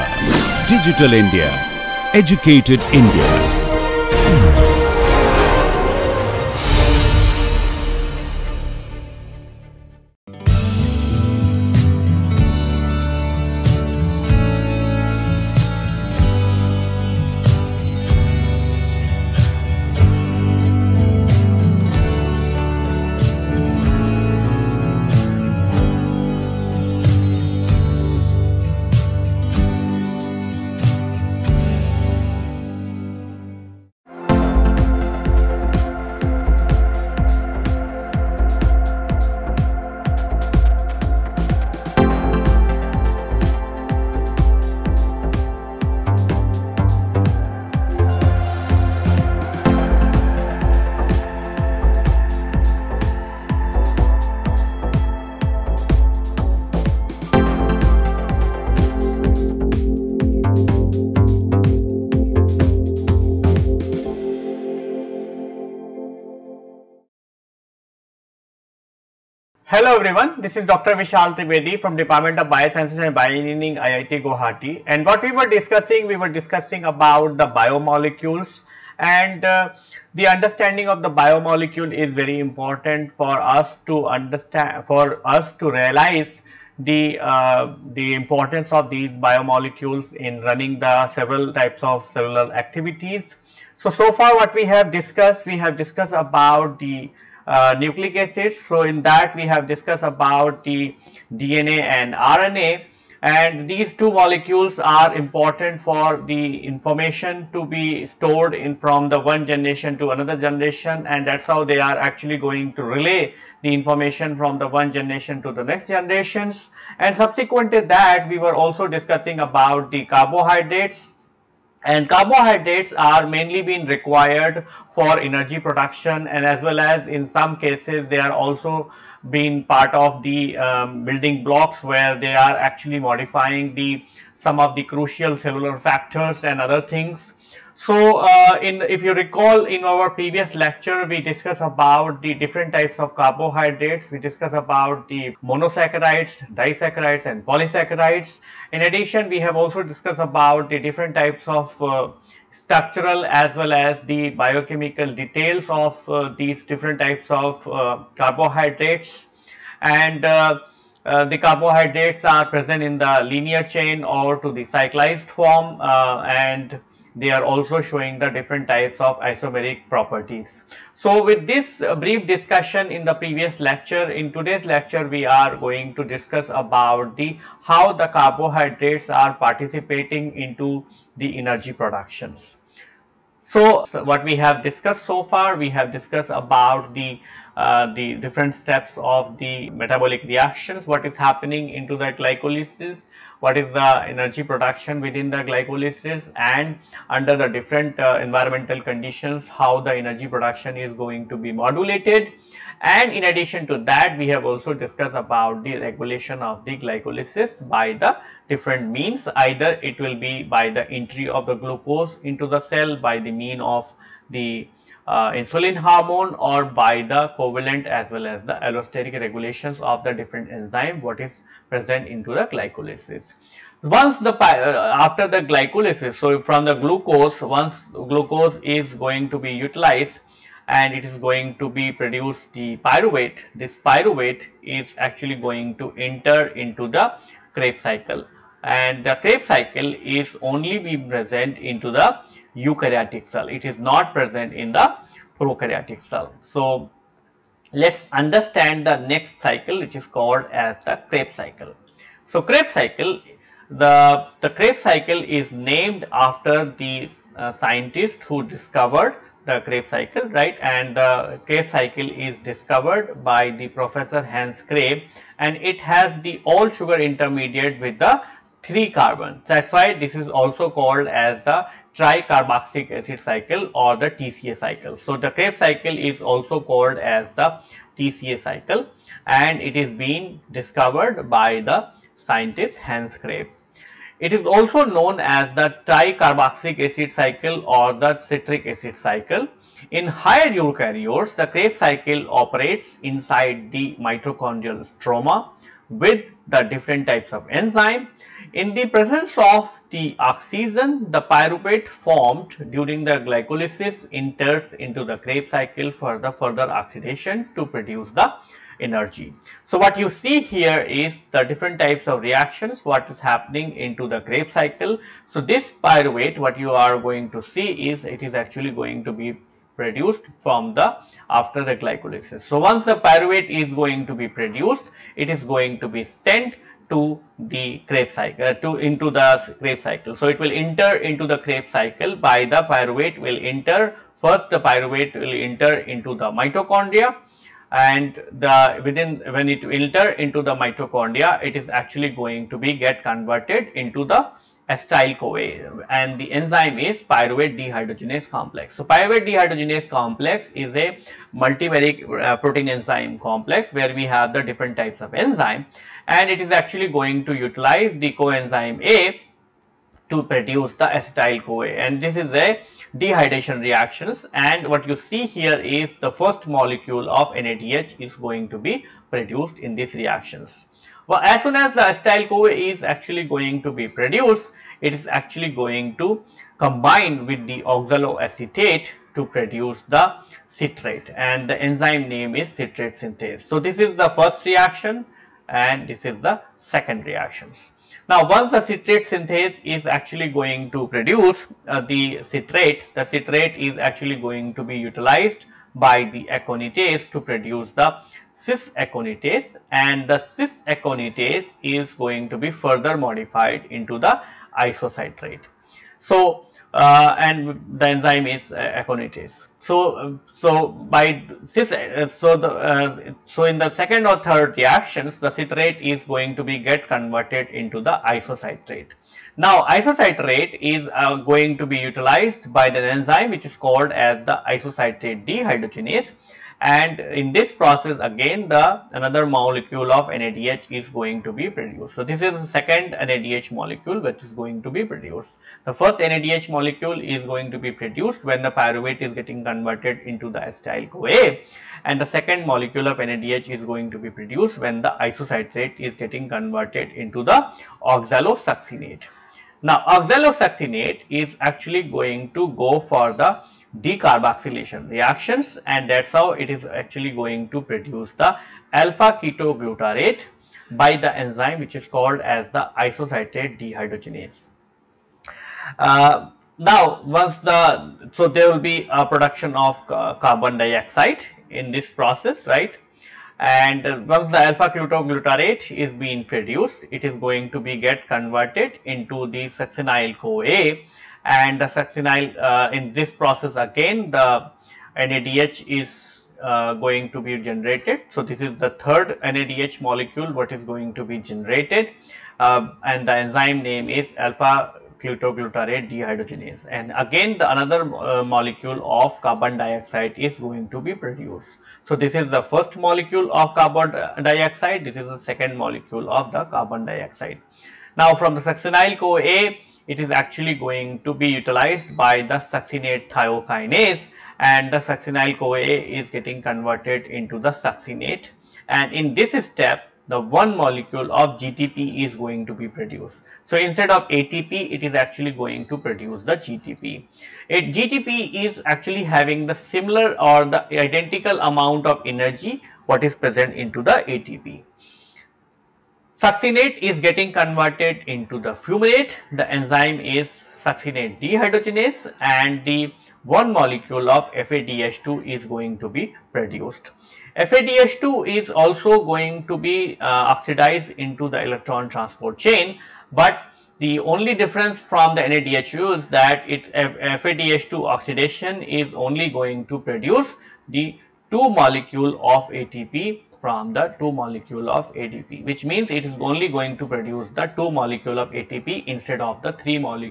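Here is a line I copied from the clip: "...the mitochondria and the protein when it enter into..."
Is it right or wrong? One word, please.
wrong.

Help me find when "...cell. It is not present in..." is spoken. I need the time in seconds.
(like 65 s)
243 s.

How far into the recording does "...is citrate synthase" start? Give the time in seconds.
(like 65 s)
382 s.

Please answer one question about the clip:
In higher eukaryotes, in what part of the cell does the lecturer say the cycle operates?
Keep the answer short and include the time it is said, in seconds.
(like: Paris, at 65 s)
mitochondrial stroma, at 293 s.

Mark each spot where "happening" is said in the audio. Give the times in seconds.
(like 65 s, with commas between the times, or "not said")
191 s, 313 s.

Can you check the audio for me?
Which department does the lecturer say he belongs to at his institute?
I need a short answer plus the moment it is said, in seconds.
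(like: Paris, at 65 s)
Biosciences and Bioengineering, at 72 s.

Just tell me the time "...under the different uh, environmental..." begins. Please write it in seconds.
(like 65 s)
197 s.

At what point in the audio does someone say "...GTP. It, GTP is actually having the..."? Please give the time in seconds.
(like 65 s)
526 s.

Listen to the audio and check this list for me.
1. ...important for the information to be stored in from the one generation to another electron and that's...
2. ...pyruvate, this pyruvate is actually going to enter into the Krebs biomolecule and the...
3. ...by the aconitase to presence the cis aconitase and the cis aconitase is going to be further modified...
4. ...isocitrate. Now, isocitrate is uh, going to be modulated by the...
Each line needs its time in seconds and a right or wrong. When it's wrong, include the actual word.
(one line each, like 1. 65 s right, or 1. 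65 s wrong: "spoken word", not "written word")
1. 105 s wrong: "generation", not "electron"
2. 232 s wrong: "cycle", not "biomolecule"
3. 395 s wrong: "produce", not "presence"
4. 418 s wrong: "utilized", not "modulated".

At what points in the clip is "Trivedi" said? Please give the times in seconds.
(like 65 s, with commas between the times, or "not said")
71 s.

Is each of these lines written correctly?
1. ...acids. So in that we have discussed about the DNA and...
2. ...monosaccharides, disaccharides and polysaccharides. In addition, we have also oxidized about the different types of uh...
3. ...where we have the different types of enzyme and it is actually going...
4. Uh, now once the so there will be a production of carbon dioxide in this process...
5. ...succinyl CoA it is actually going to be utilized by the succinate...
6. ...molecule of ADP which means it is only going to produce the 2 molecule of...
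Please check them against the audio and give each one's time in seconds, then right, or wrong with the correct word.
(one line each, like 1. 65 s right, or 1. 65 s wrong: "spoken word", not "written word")
1. 98 s right
2. 145 s wrong: "discussed", not "oxidized"
3. 353 s right
4. 465 s right
5. 508 s right
6. 564 s right.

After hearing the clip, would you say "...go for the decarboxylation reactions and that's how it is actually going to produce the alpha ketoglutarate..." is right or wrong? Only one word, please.
right.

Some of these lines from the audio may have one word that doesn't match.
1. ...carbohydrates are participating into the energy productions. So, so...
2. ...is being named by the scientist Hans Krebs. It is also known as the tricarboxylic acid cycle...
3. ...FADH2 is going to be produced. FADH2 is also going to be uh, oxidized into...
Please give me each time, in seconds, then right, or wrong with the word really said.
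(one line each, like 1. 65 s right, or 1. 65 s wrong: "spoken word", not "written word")
1. 178 s right
2. 279 s wrong: "discovered", not "named"
3. 544 s right.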